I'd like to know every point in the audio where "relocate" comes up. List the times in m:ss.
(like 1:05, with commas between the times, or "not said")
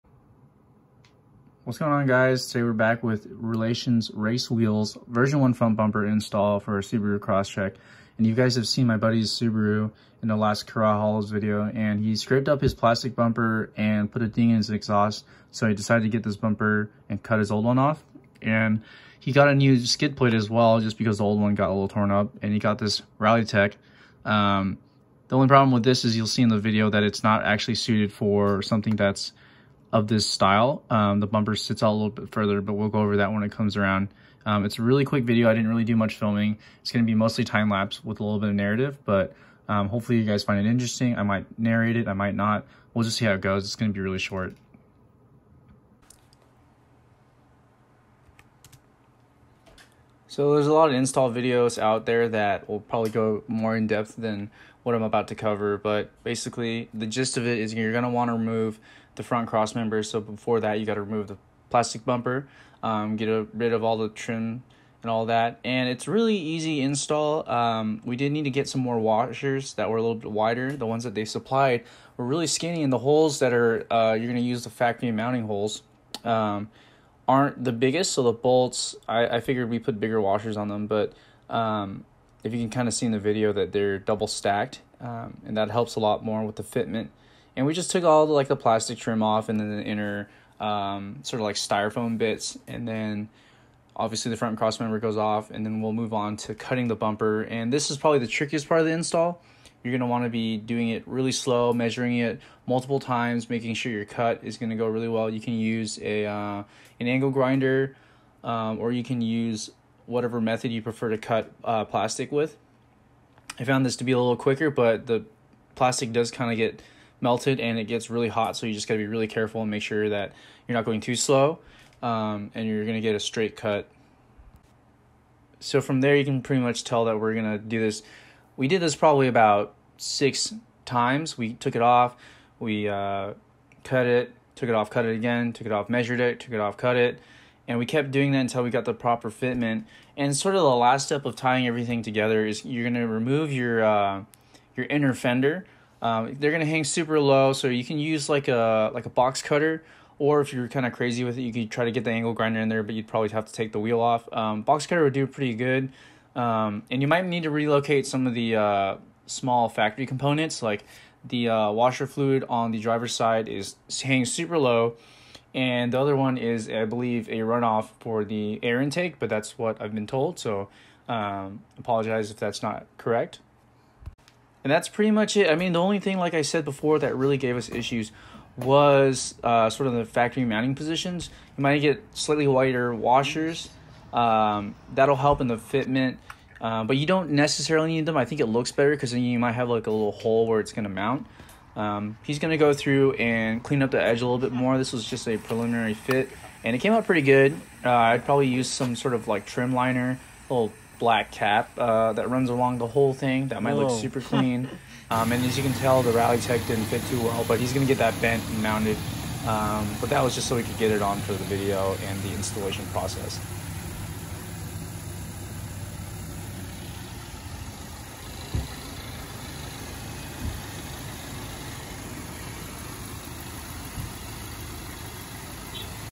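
2:37.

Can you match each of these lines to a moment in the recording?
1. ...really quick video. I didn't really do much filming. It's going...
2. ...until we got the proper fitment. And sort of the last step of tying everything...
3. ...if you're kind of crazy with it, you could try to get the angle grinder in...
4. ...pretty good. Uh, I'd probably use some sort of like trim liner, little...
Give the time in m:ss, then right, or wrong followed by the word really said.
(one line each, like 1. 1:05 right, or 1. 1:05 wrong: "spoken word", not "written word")
1. 0:34 right
2. 2:18 right
3. 2:30 right
4. 3:17 right.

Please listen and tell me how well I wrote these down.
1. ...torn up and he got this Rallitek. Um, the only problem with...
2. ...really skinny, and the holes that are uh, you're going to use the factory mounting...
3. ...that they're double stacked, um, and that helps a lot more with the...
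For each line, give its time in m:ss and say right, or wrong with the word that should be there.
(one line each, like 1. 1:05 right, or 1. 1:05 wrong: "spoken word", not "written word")
1. 0:21 right
2. 1:12 right
3. 1:23 right.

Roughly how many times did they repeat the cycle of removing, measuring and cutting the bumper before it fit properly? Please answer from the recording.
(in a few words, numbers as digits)
6.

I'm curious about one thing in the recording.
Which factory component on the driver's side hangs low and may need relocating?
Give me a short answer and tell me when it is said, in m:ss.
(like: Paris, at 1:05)
Washer fluid, at 2:41.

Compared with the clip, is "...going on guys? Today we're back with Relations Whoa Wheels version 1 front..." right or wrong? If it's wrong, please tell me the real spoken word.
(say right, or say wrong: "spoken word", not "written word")
wrong: "Race", not "Whoa".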